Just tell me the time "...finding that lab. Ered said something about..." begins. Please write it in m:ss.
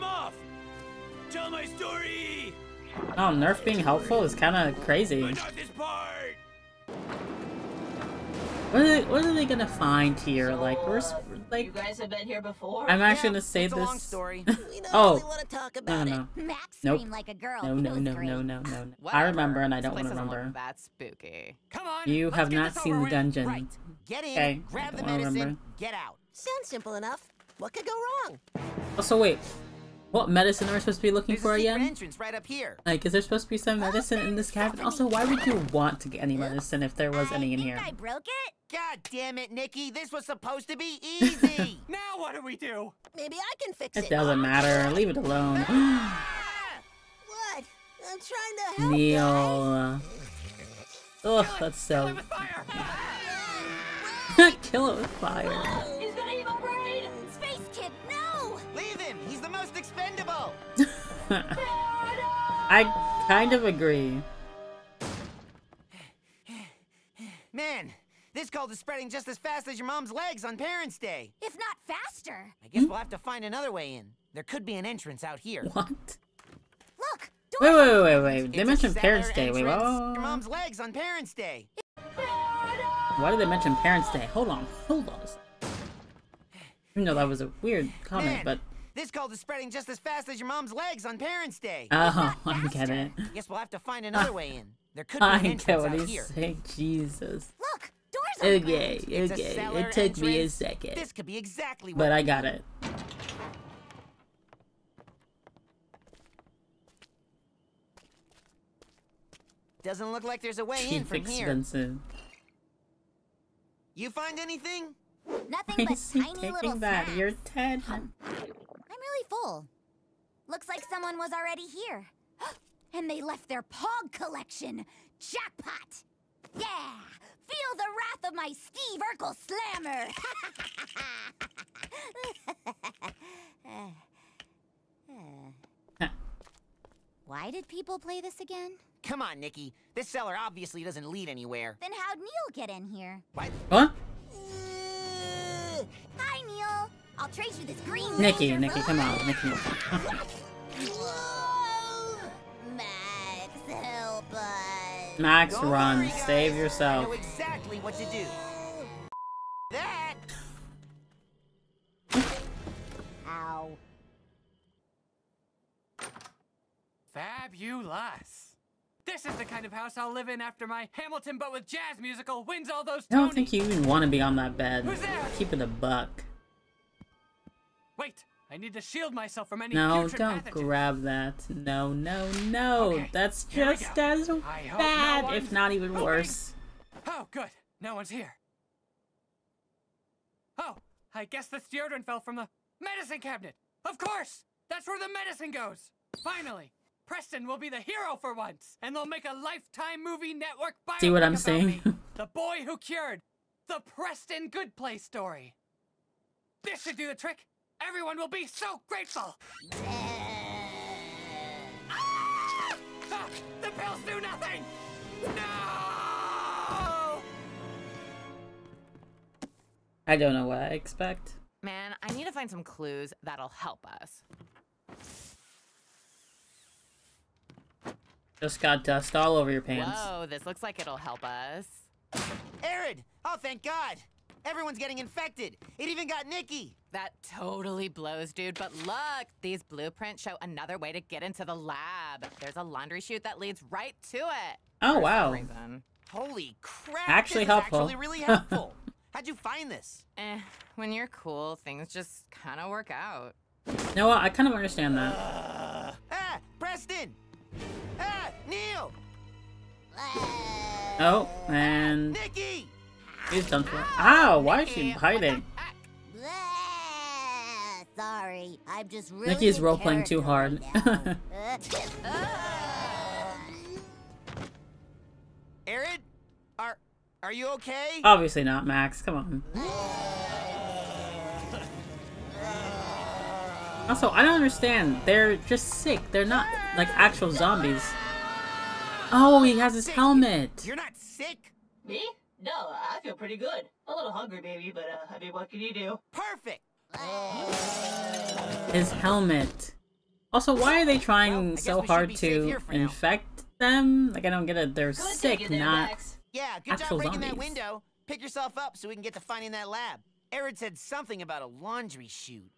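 5:09.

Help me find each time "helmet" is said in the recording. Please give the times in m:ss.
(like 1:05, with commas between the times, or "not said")
4:49, 4:58.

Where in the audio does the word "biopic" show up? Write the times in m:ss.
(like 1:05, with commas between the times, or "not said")
3:20.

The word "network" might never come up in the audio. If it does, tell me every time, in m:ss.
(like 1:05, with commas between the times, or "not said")
3:20.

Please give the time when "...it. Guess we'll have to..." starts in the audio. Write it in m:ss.
1:32.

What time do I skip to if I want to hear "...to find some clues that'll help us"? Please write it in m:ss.
3:42.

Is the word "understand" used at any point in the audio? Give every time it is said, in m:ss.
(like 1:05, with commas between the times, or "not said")
4:14, 4:44.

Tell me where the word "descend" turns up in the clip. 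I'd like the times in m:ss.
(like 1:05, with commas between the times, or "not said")
not said.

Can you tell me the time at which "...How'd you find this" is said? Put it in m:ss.
4:09.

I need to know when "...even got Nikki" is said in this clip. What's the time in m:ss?
3:55.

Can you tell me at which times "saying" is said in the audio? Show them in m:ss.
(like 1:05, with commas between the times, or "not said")
1:36, 3:21.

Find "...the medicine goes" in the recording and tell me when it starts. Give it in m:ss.
3:14.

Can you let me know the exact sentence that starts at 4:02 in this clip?
There's a laundry chute that leads right to it.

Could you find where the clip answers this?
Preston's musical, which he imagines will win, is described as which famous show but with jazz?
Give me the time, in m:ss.
2:50.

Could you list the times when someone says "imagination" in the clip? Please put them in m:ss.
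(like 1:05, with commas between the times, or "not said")
not said.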